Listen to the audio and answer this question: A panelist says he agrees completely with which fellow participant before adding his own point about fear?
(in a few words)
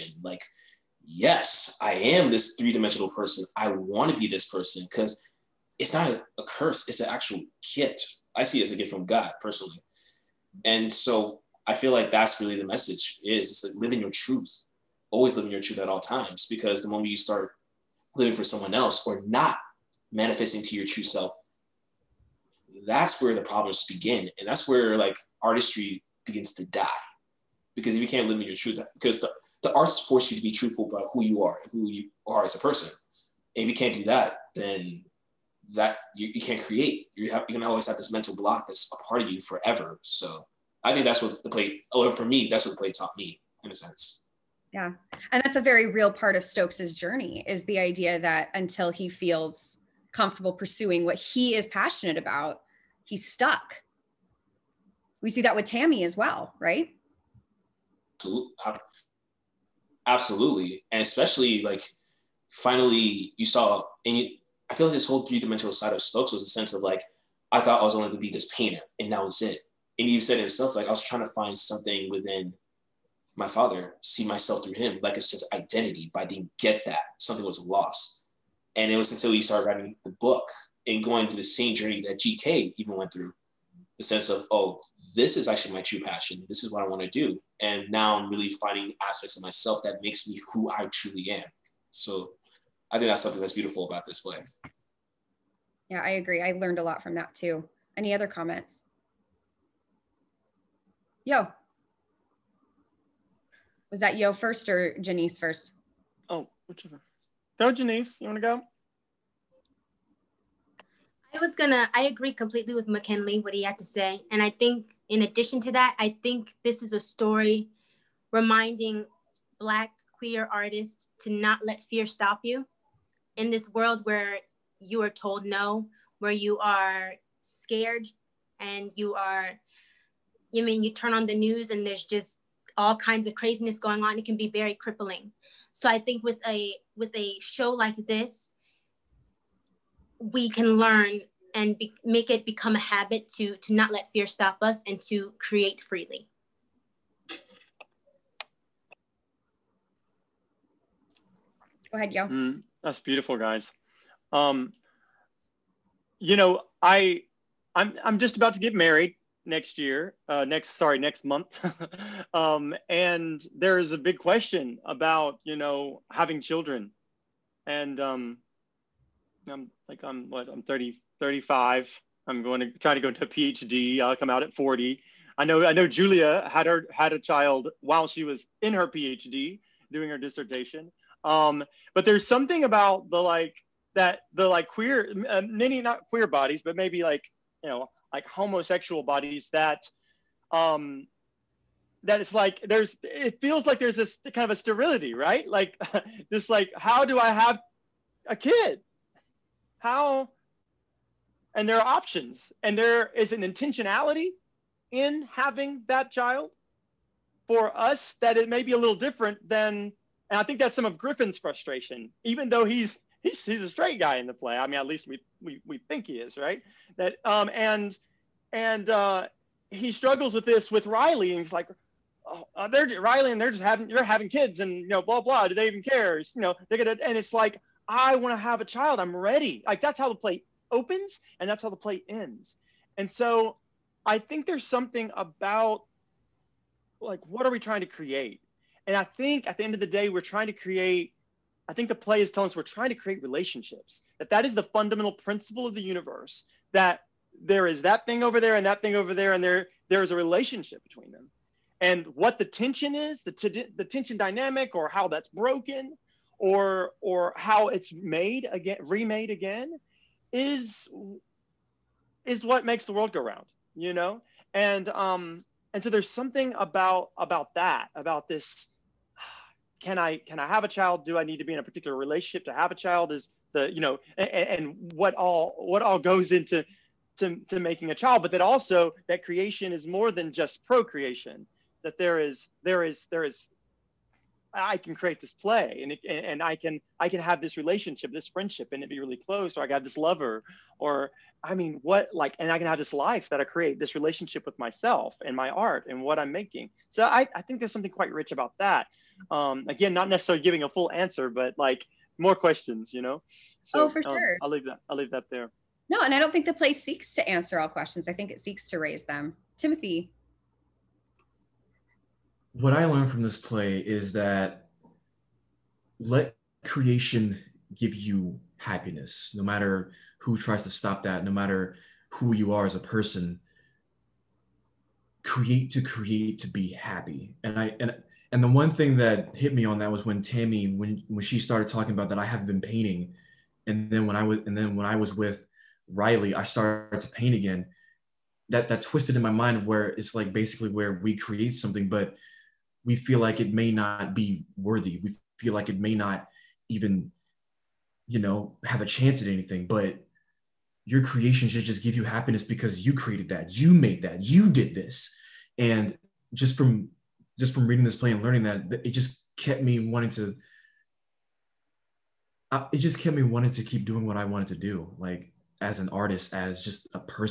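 McKinley.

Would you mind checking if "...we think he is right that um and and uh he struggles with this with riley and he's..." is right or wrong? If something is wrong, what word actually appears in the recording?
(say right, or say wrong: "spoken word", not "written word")
right.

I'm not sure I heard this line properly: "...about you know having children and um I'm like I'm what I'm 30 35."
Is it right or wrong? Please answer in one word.
right.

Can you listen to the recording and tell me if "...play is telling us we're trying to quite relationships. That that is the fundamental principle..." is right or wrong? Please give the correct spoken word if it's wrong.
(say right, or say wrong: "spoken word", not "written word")
wrong: "create", not "quite".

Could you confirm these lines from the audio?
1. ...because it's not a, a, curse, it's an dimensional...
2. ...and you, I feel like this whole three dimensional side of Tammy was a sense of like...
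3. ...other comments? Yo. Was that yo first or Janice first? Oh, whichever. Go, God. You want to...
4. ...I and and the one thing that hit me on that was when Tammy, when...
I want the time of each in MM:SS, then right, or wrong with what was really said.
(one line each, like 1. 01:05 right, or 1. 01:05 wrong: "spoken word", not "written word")
1. 00:04 wrong: "actual", not "dimensional"
2. 01:04 wrong: "Stokes", not "Tammy"
3. 01:38 wrong: "Janice", not "God"
4. 05:27 right.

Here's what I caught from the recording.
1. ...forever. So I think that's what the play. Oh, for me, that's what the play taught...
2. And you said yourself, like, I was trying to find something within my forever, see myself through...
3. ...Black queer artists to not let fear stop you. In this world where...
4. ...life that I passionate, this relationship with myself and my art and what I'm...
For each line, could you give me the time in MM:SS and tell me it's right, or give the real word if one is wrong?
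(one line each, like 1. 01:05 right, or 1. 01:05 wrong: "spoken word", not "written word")
1. 00:39 right
2. 01:09 wrong: "father", not "forever"
3. 01:59 right
4. 04:52 wrong: "create", not "passionate".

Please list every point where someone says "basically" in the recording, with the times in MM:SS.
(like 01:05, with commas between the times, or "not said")
05:40.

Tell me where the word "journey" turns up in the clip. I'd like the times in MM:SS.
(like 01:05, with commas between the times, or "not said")
00:46, 01:21.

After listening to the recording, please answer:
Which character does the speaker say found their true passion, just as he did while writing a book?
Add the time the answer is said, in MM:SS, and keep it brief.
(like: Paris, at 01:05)
GK, at 01:22.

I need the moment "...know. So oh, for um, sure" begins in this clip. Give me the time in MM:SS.
05:03.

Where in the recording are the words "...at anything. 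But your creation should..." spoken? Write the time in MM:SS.
05:49.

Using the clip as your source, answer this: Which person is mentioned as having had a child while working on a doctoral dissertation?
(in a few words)
Julia.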